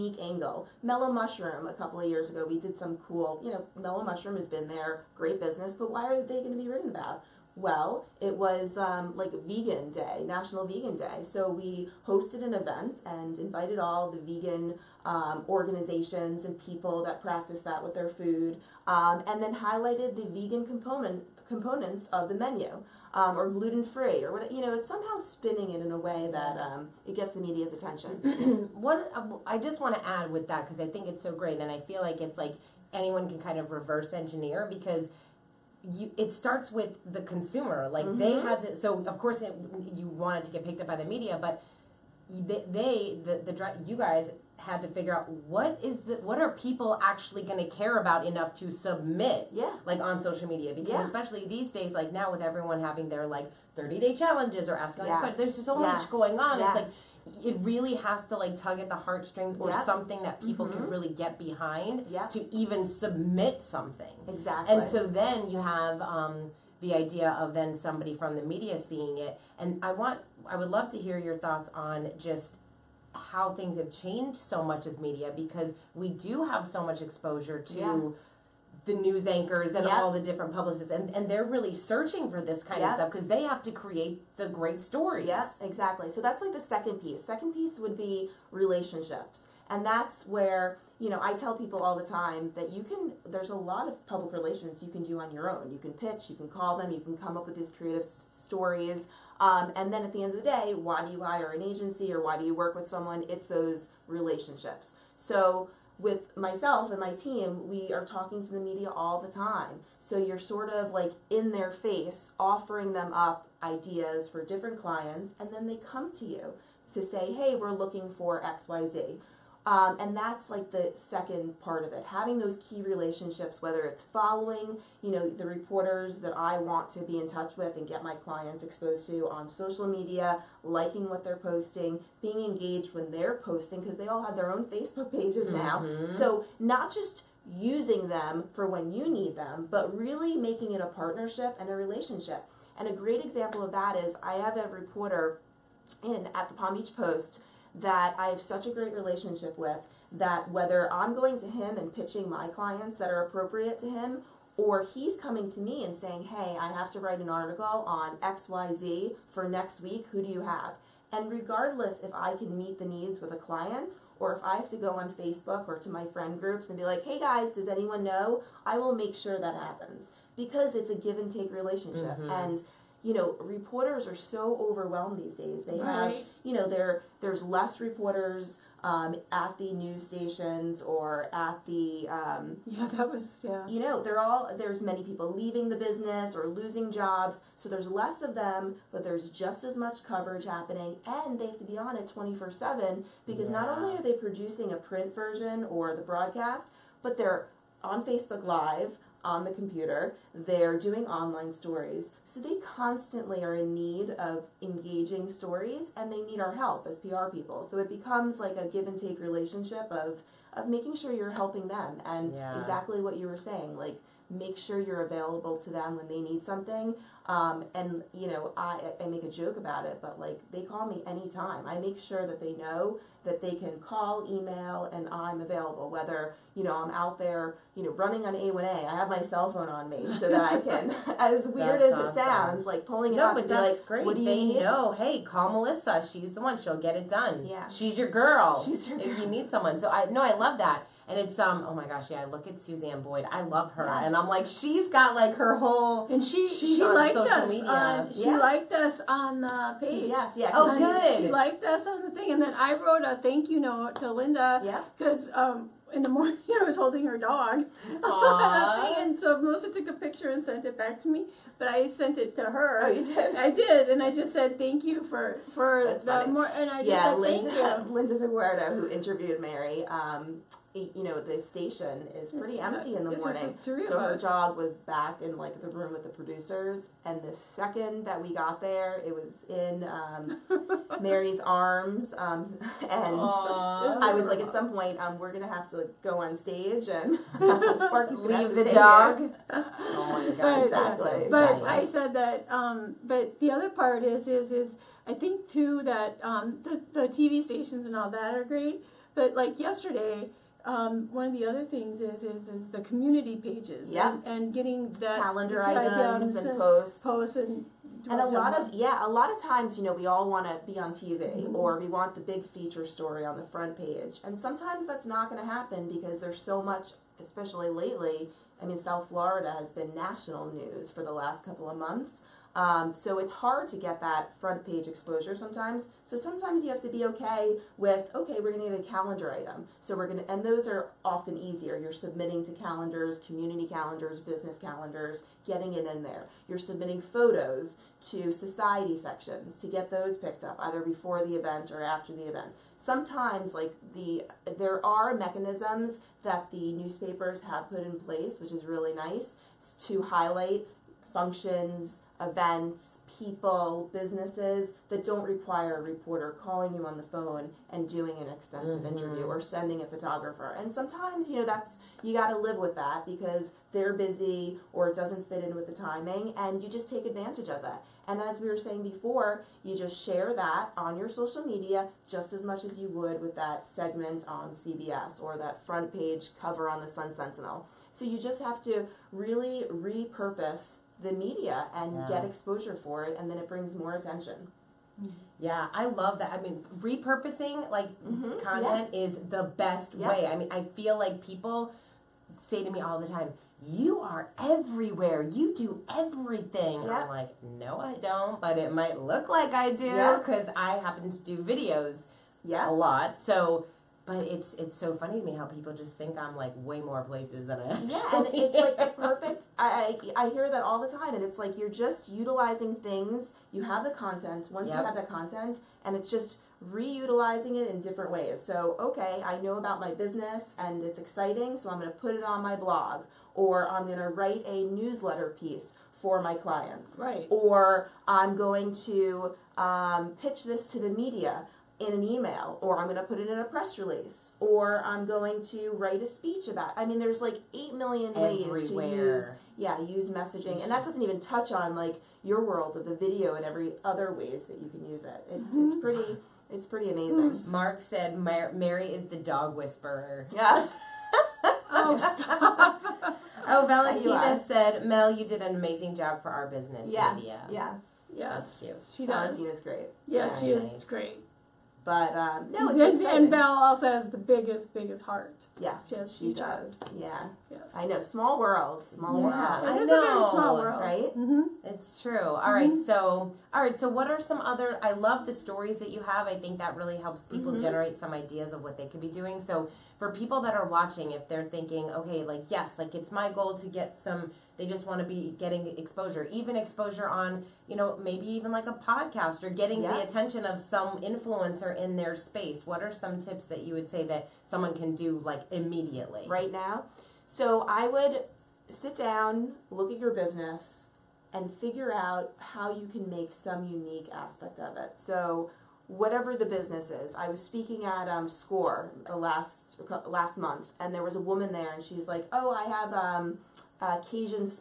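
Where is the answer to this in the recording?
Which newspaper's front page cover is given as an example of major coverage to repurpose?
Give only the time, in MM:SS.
06:16.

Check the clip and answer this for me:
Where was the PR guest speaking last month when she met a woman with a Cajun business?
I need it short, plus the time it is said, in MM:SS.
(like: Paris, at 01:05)
Score, at 08:28.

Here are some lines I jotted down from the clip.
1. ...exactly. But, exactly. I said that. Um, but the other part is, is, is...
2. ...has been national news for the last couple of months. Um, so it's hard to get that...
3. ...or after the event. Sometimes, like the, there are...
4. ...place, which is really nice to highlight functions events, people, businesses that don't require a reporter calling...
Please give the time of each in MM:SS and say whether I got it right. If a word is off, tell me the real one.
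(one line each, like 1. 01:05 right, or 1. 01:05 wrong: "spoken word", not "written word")
1. 04:50 right
2. 05:19 right
3. 05:41 right
4. 05:47 right.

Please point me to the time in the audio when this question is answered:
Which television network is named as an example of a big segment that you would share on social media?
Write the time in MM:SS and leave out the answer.
06:14.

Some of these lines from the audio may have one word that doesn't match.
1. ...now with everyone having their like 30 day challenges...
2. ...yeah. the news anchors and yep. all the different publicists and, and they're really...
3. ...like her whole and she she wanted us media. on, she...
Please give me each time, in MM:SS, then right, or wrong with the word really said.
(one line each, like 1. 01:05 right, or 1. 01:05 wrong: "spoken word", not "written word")
1. 00:52 right
2. 01:17 right
3. 04:05 wrong: "liked", not "wanted".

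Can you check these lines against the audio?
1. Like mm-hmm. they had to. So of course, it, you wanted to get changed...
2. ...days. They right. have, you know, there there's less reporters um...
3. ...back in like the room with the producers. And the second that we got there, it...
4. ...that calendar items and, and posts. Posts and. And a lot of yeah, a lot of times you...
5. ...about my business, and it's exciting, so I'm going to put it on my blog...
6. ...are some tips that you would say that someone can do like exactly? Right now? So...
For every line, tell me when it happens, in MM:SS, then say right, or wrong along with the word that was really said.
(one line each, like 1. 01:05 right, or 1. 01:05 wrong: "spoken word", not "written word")
1. 00:37 wrong: "picked", not "changed"
2. 02:55 right
3. 04:34 right
4. 05:04 right
5. 06:59 right
6. 08:12 wrong: "immediately", not "exactly".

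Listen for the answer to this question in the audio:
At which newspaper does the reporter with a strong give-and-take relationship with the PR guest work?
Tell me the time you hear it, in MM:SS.
02:26.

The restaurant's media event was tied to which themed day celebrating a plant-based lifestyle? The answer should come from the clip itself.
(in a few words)
National Vegan Day.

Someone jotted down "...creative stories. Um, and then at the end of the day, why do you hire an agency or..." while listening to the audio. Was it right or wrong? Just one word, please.
right.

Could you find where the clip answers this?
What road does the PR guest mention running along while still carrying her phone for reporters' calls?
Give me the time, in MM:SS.
03:48.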